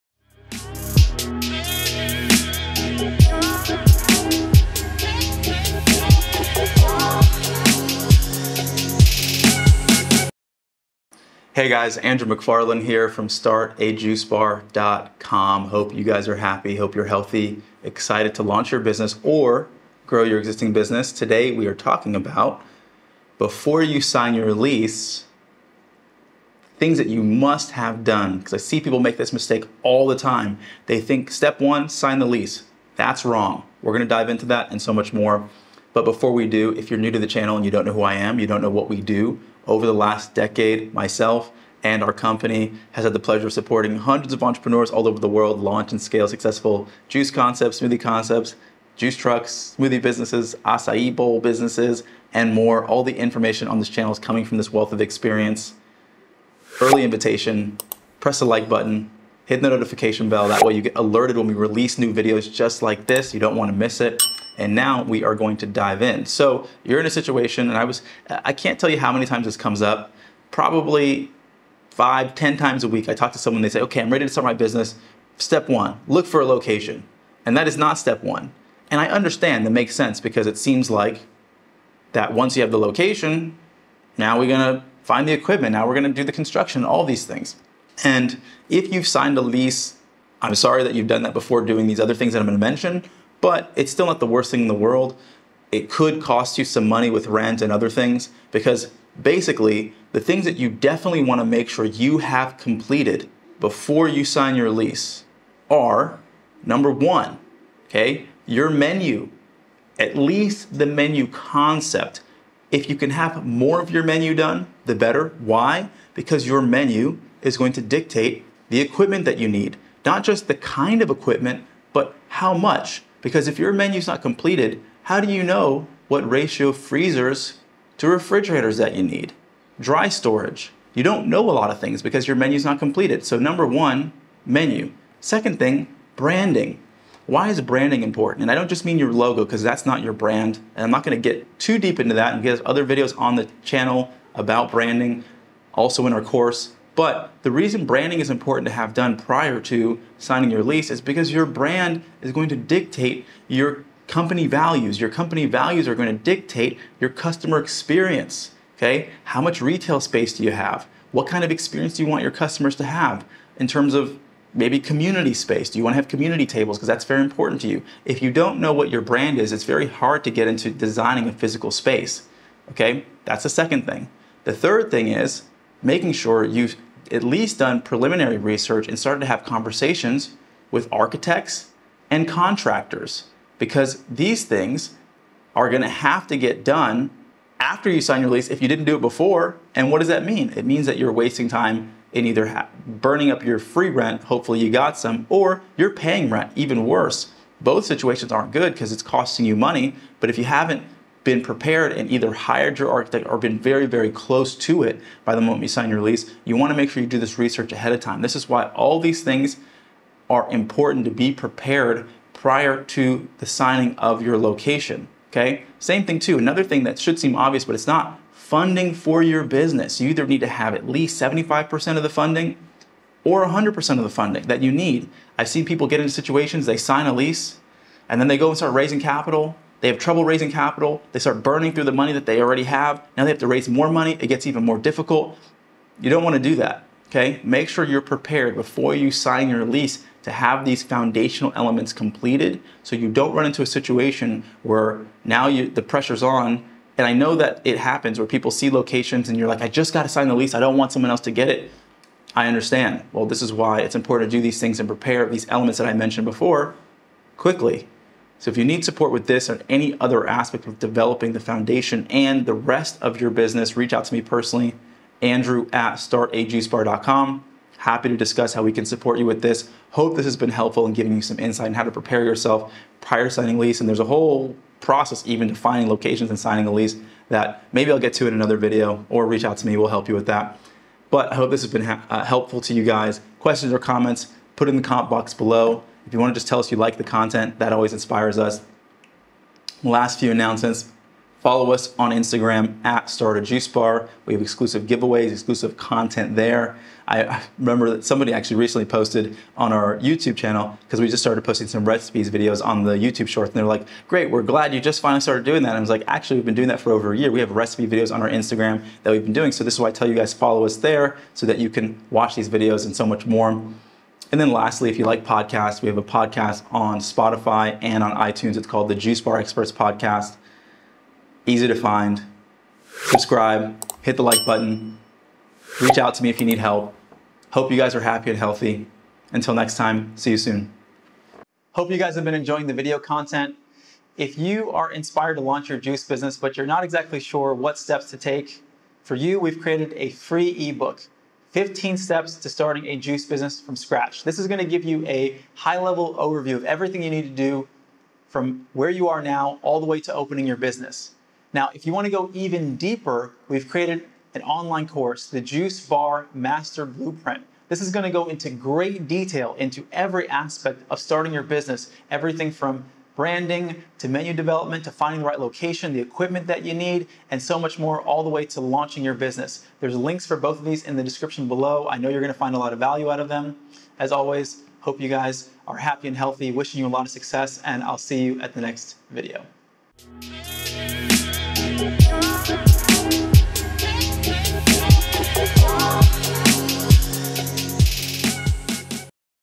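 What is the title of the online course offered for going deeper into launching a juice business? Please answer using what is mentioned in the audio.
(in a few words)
Juice Bar Master Blueprint.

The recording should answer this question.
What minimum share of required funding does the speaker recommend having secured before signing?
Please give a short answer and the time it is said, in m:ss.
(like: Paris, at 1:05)
75%, at 3:41.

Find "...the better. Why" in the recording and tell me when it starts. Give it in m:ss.
1:54.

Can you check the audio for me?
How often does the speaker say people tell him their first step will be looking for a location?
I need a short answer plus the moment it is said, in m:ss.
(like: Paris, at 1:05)
5 to 10 times a week, at 1:11.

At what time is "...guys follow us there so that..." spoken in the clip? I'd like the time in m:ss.
5:10.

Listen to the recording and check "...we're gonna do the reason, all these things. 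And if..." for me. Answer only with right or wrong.
wrong.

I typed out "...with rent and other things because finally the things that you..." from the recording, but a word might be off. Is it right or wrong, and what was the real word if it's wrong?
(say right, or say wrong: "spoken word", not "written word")
wrong: "basically", not "finally".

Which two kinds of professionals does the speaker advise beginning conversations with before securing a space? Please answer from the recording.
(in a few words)
Architects and contractors.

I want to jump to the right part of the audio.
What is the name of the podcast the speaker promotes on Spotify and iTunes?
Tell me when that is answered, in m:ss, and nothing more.
5:18.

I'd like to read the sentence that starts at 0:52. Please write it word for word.
All the information on this channel is coming from this wealth of experience.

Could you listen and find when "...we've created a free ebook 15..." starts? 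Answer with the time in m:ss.
5:39.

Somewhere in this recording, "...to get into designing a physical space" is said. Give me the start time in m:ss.
2:50.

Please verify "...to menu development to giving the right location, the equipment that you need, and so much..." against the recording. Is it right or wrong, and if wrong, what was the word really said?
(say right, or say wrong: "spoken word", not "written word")
wrong: "finding", not "giving".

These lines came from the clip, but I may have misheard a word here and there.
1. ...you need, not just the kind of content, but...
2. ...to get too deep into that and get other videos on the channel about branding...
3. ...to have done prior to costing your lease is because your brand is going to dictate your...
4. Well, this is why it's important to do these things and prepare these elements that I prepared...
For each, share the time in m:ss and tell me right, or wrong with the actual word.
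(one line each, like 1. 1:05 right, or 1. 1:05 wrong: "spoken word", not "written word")
1. 1:59 wrong: "equipment", not "content"
2. 2:21 right
3. 2:28 wrong: "signing", not "costing"
4. 4:13 wrong: "mentioned", not "prepared".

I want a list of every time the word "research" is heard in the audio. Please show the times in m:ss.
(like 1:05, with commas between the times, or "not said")
2:58, 3:27.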